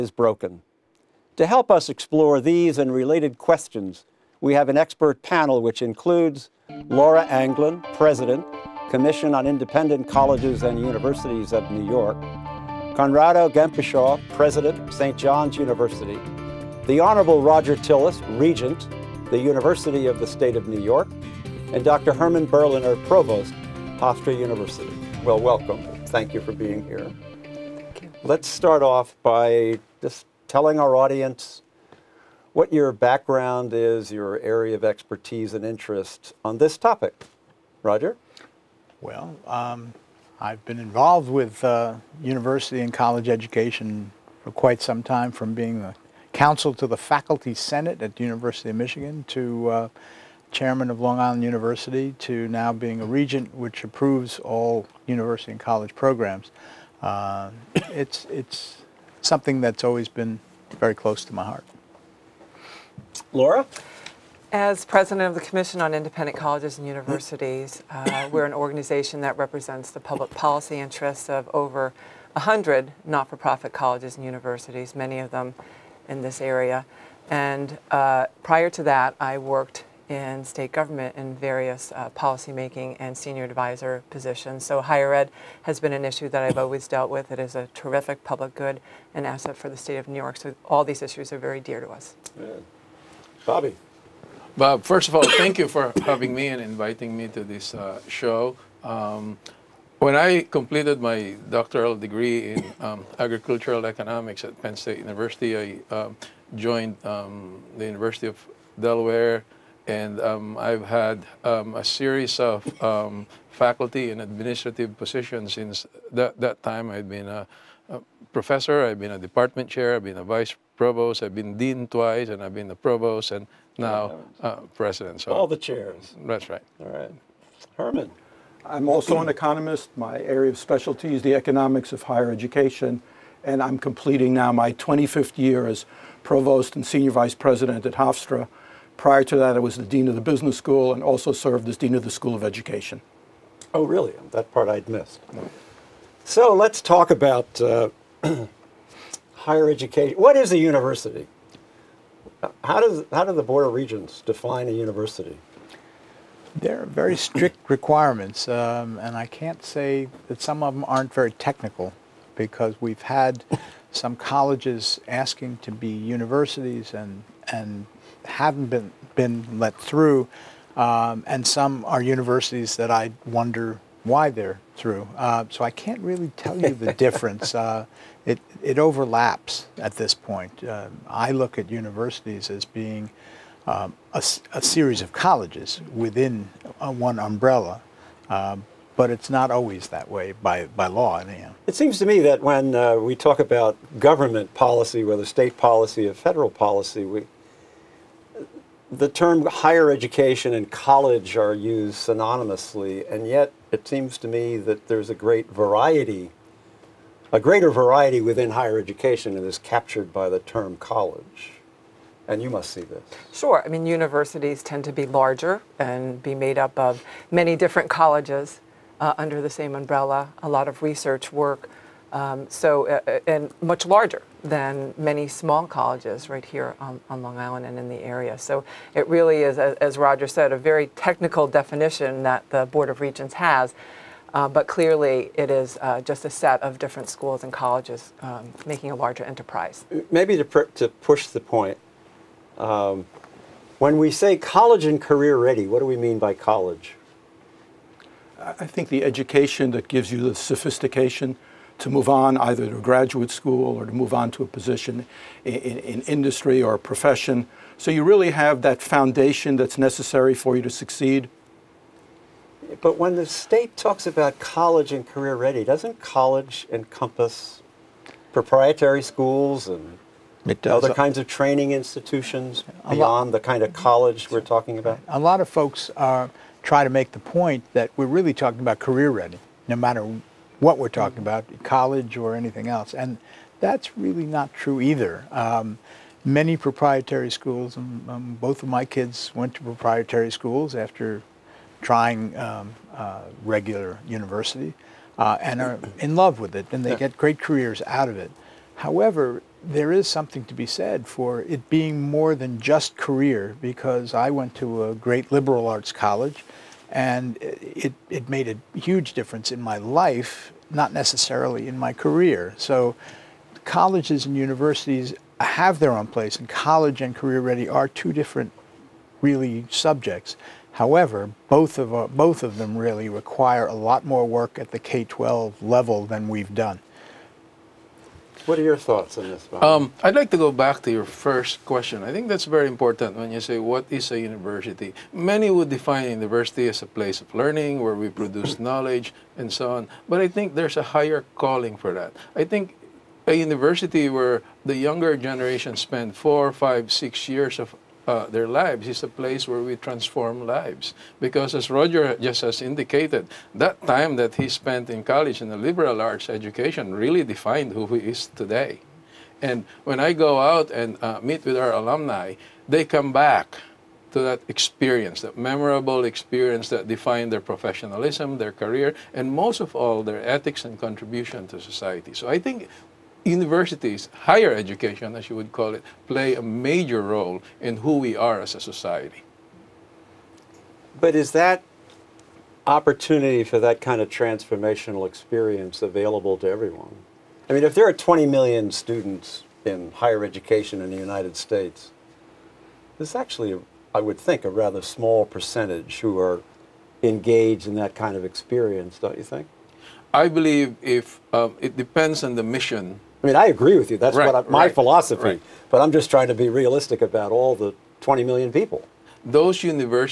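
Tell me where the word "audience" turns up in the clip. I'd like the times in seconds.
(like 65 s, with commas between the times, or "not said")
30 s.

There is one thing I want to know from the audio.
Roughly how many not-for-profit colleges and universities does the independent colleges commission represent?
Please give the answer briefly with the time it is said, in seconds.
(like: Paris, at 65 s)
over 100, at 71 s.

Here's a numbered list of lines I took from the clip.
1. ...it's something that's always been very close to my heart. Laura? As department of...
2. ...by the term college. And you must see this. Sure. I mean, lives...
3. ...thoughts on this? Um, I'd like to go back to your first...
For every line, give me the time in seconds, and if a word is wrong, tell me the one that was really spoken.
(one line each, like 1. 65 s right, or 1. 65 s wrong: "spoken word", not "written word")
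1. 58 s wrong: "president", not "department"
2. 210 s wrong: "universities", not "lives"
3. 328 s right.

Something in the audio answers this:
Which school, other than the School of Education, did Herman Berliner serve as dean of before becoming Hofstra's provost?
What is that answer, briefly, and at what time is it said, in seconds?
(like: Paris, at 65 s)
The business school, at 140 s.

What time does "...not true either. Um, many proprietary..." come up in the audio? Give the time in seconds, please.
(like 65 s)
284 s.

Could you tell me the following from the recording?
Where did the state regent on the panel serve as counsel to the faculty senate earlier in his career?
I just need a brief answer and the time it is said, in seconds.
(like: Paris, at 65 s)
University of Michigan, at 48 s.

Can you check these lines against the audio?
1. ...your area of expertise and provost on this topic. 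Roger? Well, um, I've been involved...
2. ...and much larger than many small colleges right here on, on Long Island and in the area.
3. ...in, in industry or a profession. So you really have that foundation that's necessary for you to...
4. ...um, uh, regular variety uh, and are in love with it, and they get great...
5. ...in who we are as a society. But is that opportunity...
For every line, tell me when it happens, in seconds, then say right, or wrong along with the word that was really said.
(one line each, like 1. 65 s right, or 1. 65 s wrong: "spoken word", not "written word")
1. 34 s wrong: "interest", not "provost"
2. 223 s right
3. 255 s right
4. 292 s wrong: "university", not "variety"
5. 377 s right.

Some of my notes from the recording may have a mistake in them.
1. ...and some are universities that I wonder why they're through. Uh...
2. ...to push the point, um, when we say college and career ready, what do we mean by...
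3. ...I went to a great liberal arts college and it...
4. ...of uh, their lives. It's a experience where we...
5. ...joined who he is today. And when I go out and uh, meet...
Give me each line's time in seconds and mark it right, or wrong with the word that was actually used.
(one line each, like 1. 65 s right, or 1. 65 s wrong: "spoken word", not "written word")
1. 171 s right
2. 240 s right
3. 304 s right
4. 347 s wrong: "place", not "experience"
5. 357 s wrong: "defined", not "joined".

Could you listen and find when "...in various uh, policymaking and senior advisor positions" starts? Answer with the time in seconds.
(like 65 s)
81 s.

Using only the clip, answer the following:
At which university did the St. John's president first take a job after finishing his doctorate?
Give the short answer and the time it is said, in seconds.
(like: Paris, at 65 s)
University of Delaware, at 107 s.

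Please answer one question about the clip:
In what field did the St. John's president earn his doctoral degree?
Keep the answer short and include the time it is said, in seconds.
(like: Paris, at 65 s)
Agricultural economics, at 103 s.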